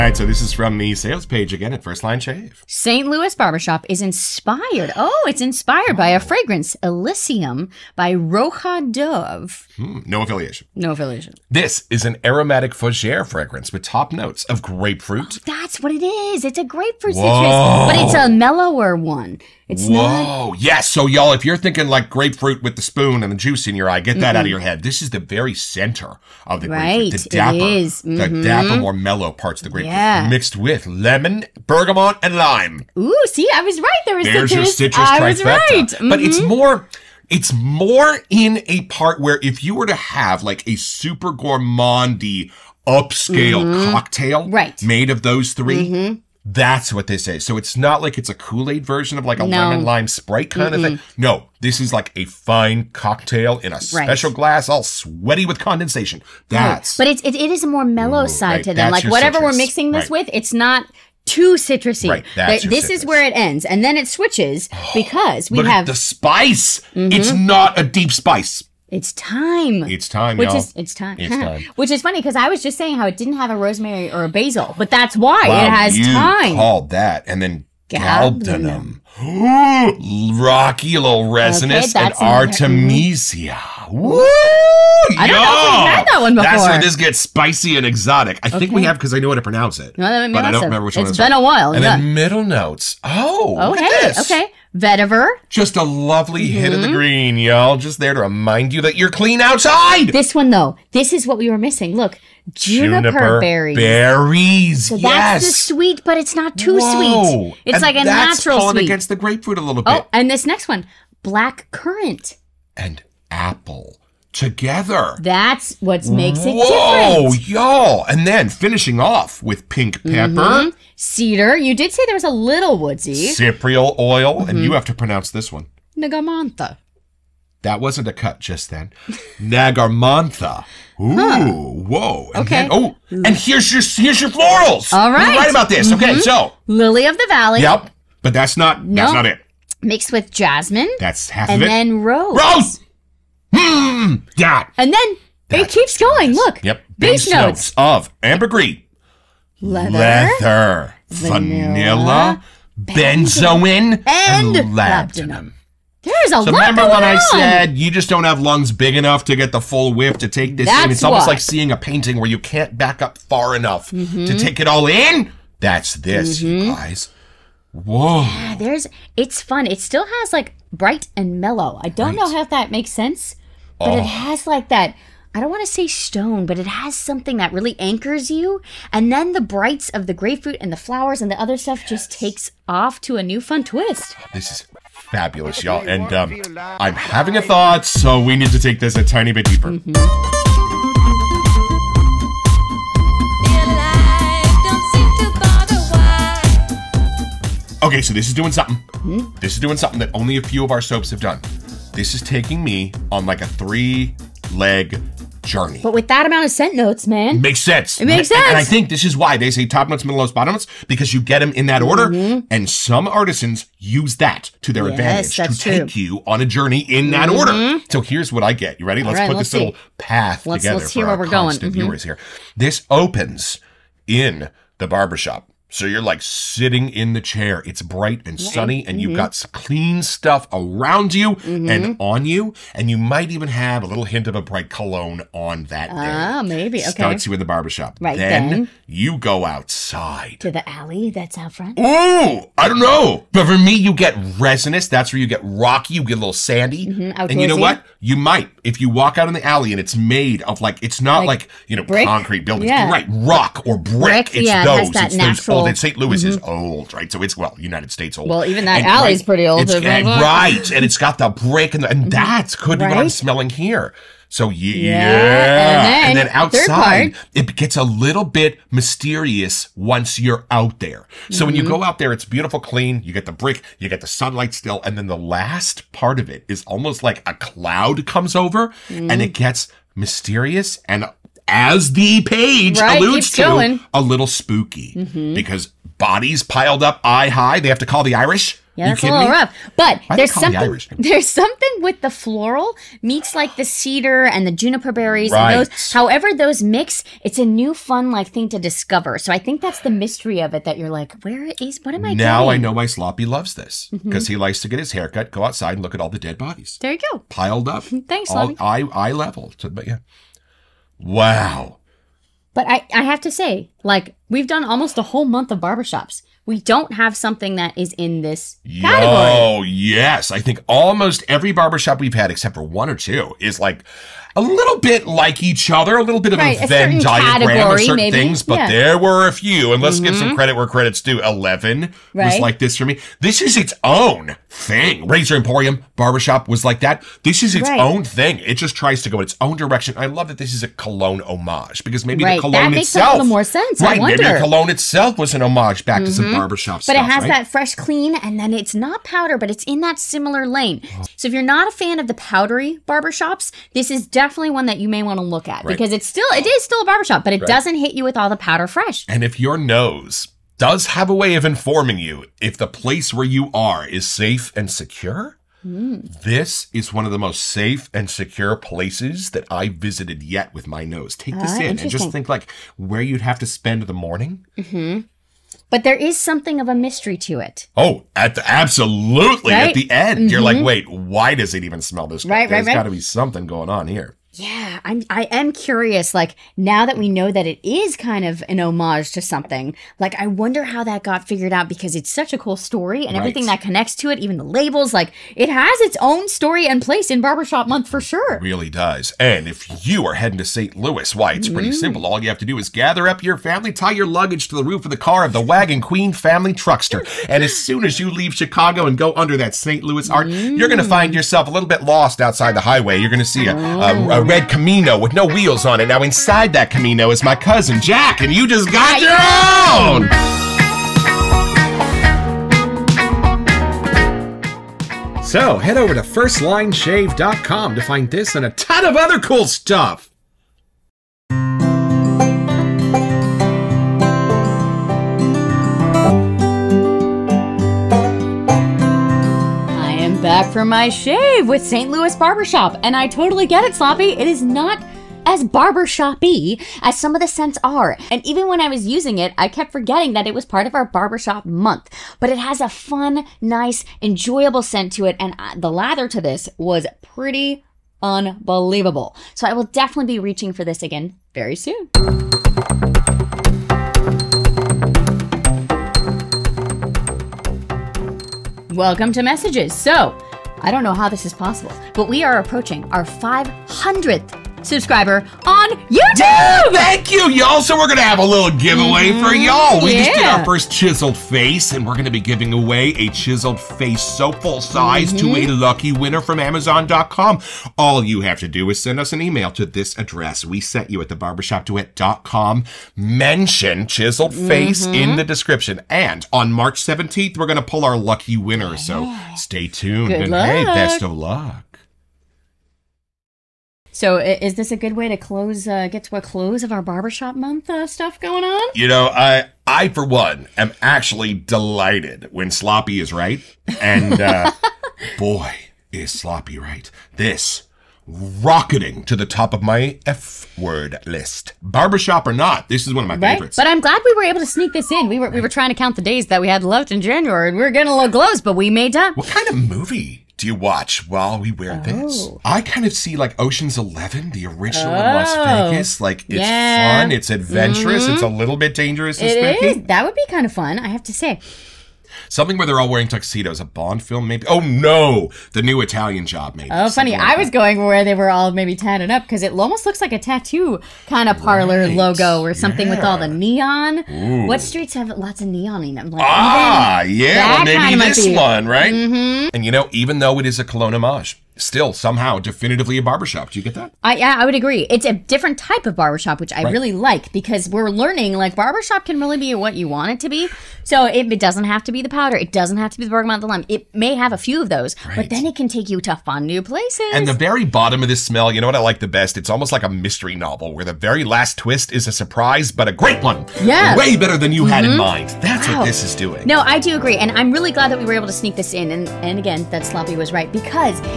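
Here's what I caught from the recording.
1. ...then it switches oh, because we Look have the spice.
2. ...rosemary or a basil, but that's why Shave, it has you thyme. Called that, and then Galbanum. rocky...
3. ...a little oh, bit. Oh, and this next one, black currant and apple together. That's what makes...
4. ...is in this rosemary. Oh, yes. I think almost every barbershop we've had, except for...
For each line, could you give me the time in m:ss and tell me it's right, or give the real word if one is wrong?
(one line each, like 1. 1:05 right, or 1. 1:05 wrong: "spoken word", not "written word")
1. 1:03 right
2. 1:13 wrong: "Wow", not "Shave"
3. 1:49 right
4. 5:17 wrong: "category", not "rosemary".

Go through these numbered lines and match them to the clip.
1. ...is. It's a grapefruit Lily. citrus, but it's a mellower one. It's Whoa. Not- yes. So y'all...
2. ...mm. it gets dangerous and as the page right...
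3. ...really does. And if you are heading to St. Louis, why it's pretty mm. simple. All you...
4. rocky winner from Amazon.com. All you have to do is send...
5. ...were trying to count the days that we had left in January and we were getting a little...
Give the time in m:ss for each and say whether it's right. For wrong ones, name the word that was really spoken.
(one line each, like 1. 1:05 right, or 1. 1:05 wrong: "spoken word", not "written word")
1. 0:16 wrong: "Whoa", not "Lily"
2. 4:39 wrong: "mysterious", not "dangerous"
3. 6:38 right
4. 8:05 wrong: "lucky", not "rocky"
5. 8:45 right.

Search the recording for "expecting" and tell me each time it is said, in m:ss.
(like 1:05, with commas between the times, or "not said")
not said.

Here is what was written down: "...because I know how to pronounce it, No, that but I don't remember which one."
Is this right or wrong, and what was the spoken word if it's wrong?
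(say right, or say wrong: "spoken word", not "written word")
right.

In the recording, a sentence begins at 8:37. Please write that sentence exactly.
This rocketing to the top of my F word list.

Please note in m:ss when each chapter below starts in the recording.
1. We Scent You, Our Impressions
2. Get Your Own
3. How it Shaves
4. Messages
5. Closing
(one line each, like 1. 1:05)
1. 3:11
2. 6:59
3. 7:11
4. 7:42
5. 8:23.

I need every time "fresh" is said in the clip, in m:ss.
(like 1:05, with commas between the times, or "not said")
5:47, 5:58.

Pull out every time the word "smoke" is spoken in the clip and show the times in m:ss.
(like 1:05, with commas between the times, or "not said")
not said.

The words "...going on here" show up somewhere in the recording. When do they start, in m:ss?
6:23.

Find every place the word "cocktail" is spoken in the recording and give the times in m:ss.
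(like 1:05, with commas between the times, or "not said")
0:43, 0:52.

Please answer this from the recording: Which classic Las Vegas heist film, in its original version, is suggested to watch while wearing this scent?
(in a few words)
Ocean's Eleven.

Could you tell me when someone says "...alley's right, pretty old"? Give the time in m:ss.
4:18.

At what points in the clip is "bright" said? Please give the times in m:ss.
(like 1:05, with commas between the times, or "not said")
2:50, 2:59, 3:47, 3:54.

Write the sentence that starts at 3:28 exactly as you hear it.
And, I think this is why they say top notes, middle notes, bottom notes, because you get them in that order.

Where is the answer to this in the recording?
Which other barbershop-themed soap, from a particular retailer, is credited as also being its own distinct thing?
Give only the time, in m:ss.
5:35.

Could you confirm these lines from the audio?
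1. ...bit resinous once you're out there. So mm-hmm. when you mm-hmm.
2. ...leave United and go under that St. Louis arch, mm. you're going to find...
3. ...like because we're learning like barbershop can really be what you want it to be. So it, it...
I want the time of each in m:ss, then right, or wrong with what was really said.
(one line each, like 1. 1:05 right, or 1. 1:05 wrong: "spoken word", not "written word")
1. 4:28 wrong: "mysterious", not "resinous"
2. 6:48 wrong: "Chicago", not "United"
3. 9:26 right.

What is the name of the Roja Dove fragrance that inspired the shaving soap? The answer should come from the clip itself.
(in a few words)
Elysium.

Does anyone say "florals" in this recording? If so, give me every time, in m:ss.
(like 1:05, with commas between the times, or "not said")
2:14, 4:52.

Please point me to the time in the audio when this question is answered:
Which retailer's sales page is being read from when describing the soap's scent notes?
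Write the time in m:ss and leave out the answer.
0:01.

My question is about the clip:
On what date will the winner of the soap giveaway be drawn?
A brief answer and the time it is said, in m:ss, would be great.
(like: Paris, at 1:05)
March 17th, at 8:16.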